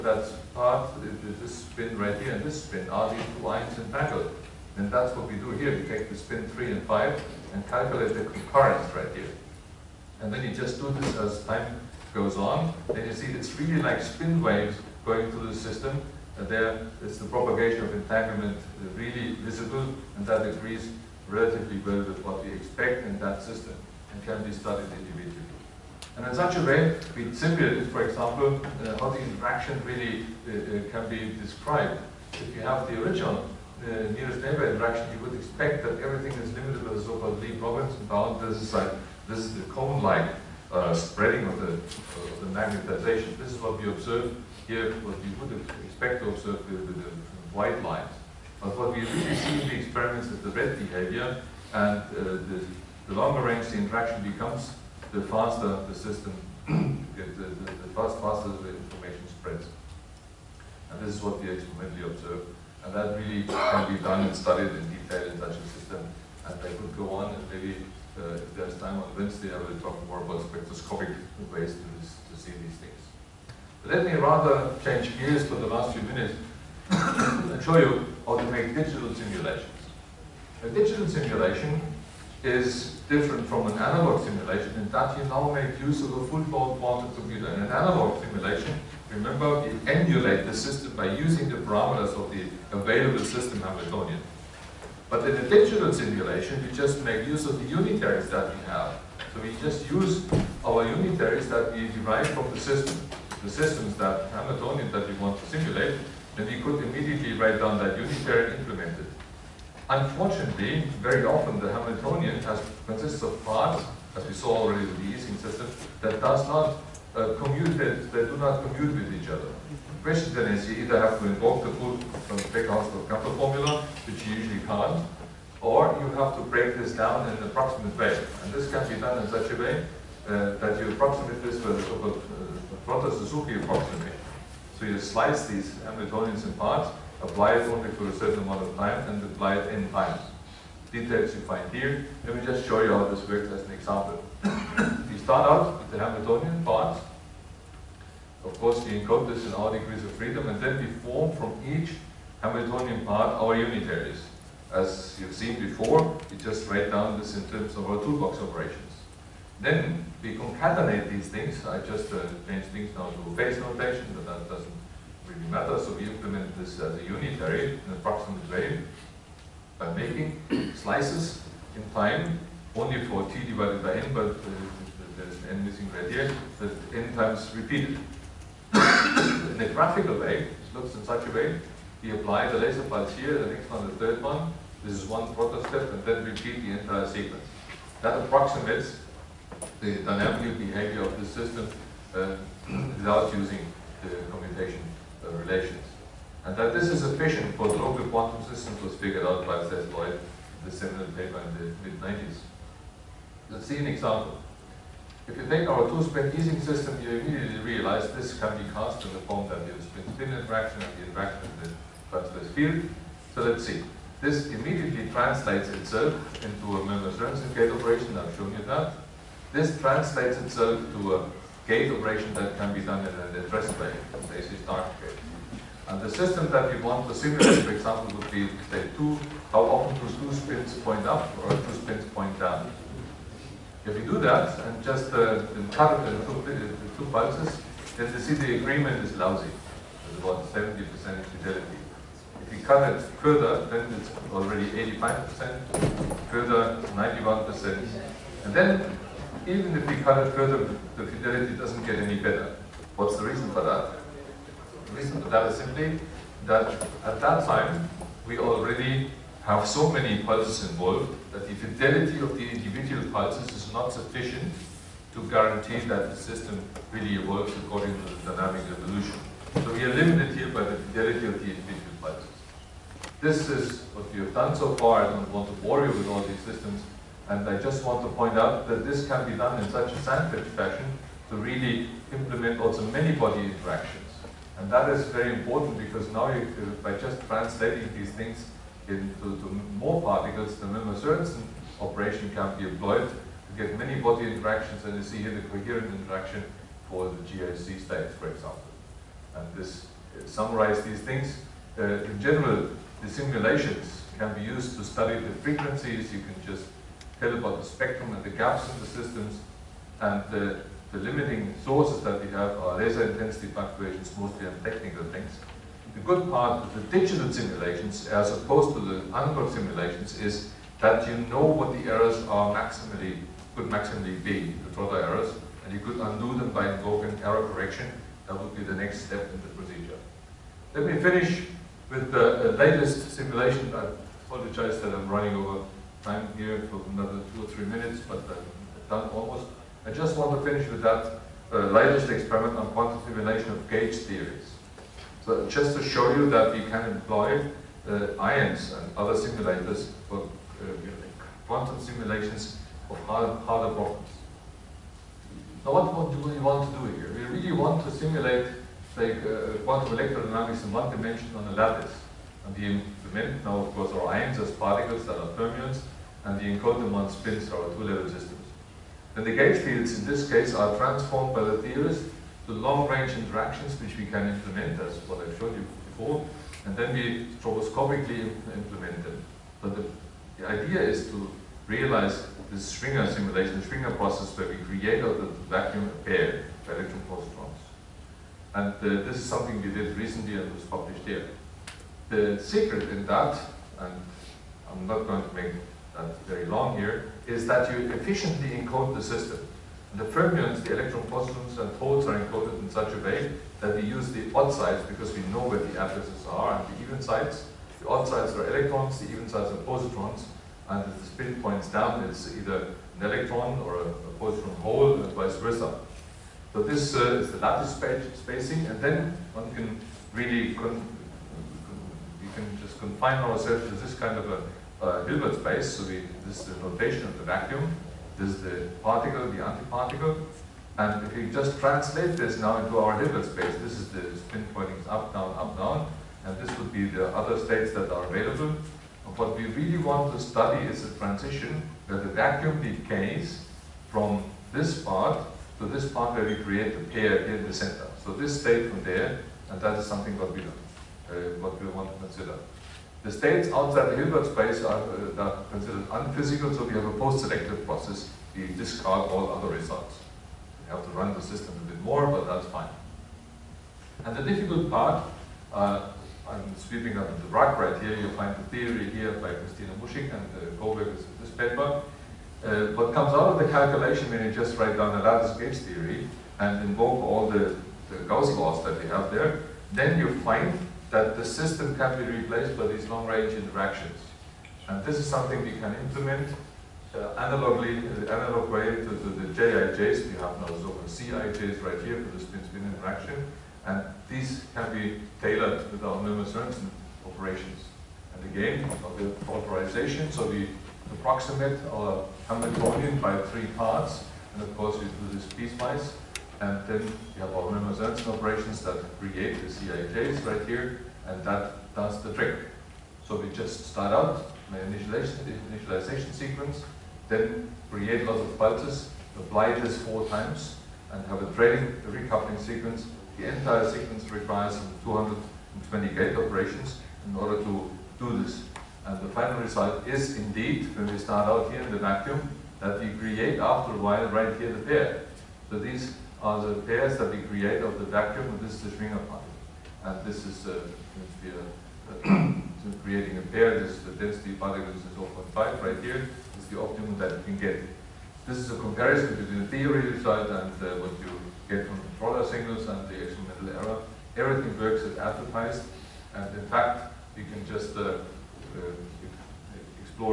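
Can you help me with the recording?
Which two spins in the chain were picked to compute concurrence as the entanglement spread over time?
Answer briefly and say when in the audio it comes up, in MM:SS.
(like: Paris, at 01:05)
3 and 5, at 00:06.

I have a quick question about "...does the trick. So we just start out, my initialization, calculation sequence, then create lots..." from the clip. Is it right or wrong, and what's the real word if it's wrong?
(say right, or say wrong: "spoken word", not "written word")
wrong: "initialization", not "calculation".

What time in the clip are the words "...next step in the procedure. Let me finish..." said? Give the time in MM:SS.
05:28.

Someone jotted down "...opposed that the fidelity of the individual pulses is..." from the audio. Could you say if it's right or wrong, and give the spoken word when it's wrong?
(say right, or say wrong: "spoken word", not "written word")
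wrong: "involved", not "opposed".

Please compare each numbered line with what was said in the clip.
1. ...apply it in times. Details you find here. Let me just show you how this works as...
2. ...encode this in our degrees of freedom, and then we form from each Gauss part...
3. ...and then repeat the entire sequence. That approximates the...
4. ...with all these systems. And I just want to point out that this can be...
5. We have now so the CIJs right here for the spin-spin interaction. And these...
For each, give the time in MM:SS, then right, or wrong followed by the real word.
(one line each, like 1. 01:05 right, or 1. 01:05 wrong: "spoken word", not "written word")
1. 02:19 right
2. 02:28 wrong: "Hamiltonian", not "Gauss"
3. 03:05 right
4. 04:35 right
5. 08:10 right.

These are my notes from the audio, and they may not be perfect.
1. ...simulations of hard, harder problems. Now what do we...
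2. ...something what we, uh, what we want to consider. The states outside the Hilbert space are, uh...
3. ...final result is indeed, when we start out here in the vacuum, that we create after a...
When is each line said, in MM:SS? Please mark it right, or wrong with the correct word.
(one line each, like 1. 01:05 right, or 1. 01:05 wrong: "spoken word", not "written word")
1. 05:51 right
2. 07:29 right
3. 08:49 right.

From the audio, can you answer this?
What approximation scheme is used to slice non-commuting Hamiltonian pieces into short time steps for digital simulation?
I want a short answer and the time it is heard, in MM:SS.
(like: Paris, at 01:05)
Suzuki approximation, at 02:13.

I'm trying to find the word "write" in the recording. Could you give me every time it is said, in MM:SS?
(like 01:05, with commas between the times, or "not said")
01:47, 02:36, 07:54.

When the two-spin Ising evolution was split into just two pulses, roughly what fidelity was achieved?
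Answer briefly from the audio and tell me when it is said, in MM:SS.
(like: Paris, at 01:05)
70%, at 04:00.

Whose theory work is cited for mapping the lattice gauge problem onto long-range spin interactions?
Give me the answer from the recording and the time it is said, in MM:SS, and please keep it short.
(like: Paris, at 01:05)
Christina Muschik, at 07:49.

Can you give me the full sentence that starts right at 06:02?
And the implement now, of course, our ions as particles that are fermions, and the encoding them spins, are two-level systems.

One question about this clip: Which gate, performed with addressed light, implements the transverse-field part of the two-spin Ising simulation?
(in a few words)
AC Stark gate.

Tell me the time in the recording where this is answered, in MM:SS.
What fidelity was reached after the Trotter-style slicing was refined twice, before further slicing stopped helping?
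04:06.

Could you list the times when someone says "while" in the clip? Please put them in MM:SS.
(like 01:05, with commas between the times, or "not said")
08:53.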